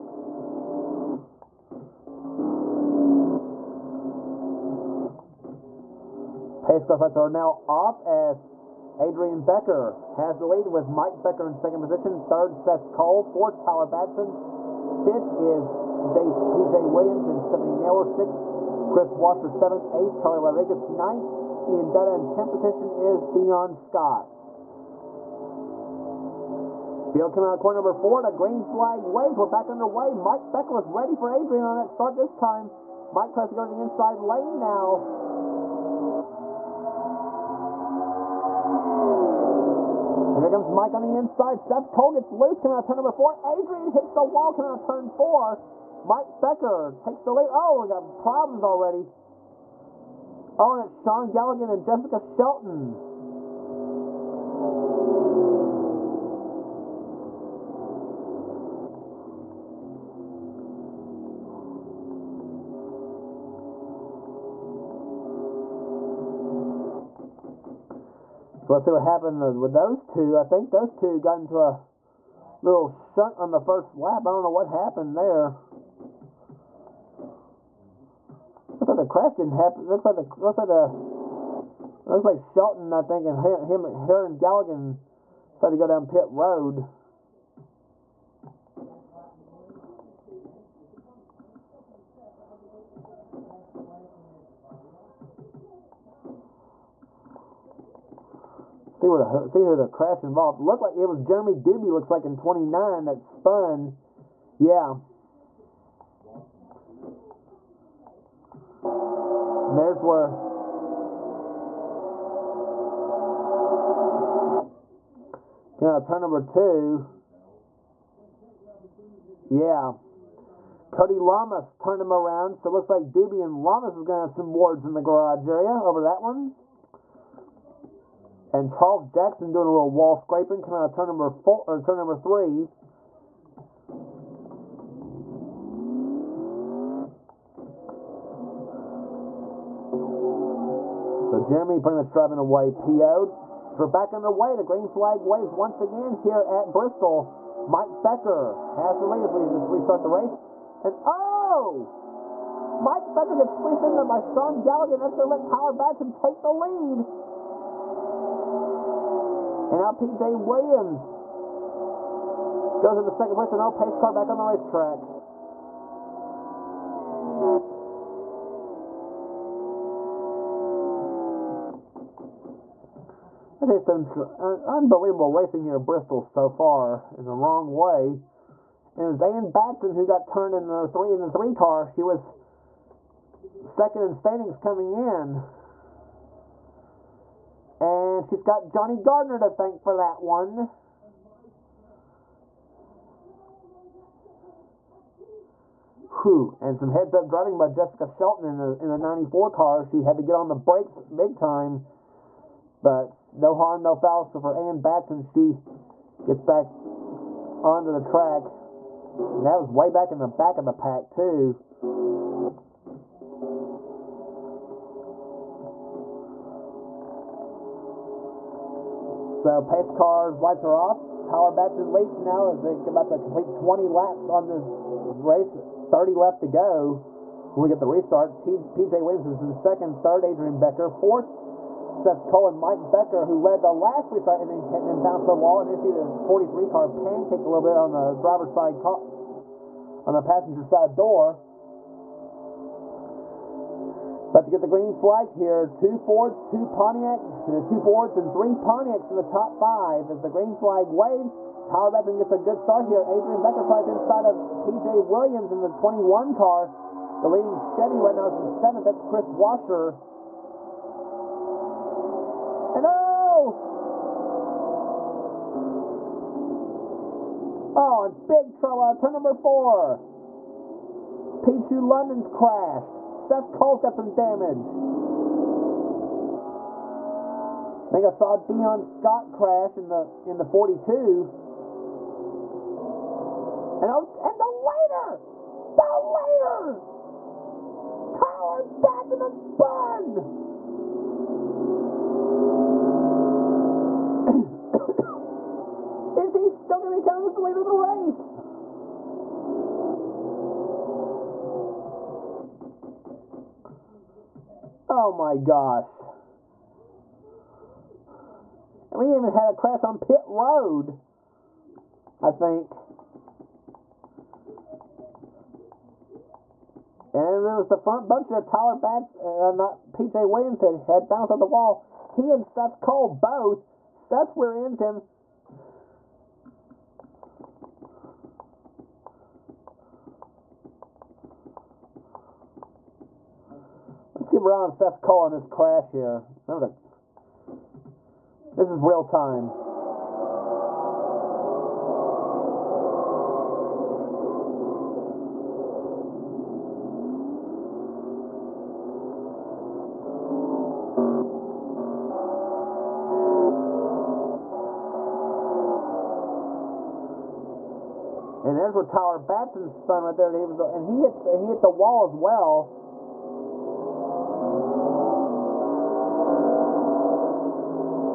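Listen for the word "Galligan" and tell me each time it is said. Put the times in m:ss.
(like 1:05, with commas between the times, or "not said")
0:51, 1:24, 2:34.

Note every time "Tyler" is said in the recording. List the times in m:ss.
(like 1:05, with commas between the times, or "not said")
0:13, 2:35, 3:41, 4:11, 5:18, 5:58.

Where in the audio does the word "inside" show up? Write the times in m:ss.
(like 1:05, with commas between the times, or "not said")
0:33, 0:41, 4:13.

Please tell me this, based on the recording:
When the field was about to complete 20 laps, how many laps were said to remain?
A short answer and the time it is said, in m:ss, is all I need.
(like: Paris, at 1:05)
30, at 3:45.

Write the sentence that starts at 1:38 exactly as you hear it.
See where the see who the crash involved.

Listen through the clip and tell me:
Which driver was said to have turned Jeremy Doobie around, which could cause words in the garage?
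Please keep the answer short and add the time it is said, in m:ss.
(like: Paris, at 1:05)
Cody Lamas, at 2:00.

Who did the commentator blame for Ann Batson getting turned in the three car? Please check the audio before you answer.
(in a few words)
Johnny Gardner.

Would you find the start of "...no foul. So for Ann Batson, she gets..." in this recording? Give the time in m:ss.
3:23.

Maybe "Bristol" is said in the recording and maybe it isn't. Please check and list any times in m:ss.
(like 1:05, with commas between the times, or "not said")
2:26, 2:55.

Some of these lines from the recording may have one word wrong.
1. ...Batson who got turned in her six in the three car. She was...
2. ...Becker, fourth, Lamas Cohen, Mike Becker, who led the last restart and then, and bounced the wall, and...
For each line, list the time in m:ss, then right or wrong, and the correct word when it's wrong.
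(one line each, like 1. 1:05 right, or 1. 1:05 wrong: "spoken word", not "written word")
1. 2:59 wrong: "three", not "six"
2. 3:50 wrong: "Seth", not "Lamas".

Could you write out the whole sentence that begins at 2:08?
And Charles Jackson doing a little wall scraping, coming out turn number four or turn number three.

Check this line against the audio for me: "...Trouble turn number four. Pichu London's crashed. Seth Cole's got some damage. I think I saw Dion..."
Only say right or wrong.
right.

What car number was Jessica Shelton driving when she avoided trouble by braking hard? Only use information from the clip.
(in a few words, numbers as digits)
94.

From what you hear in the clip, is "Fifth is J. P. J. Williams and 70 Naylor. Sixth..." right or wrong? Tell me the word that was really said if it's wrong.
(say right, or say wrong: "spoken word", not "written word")
right.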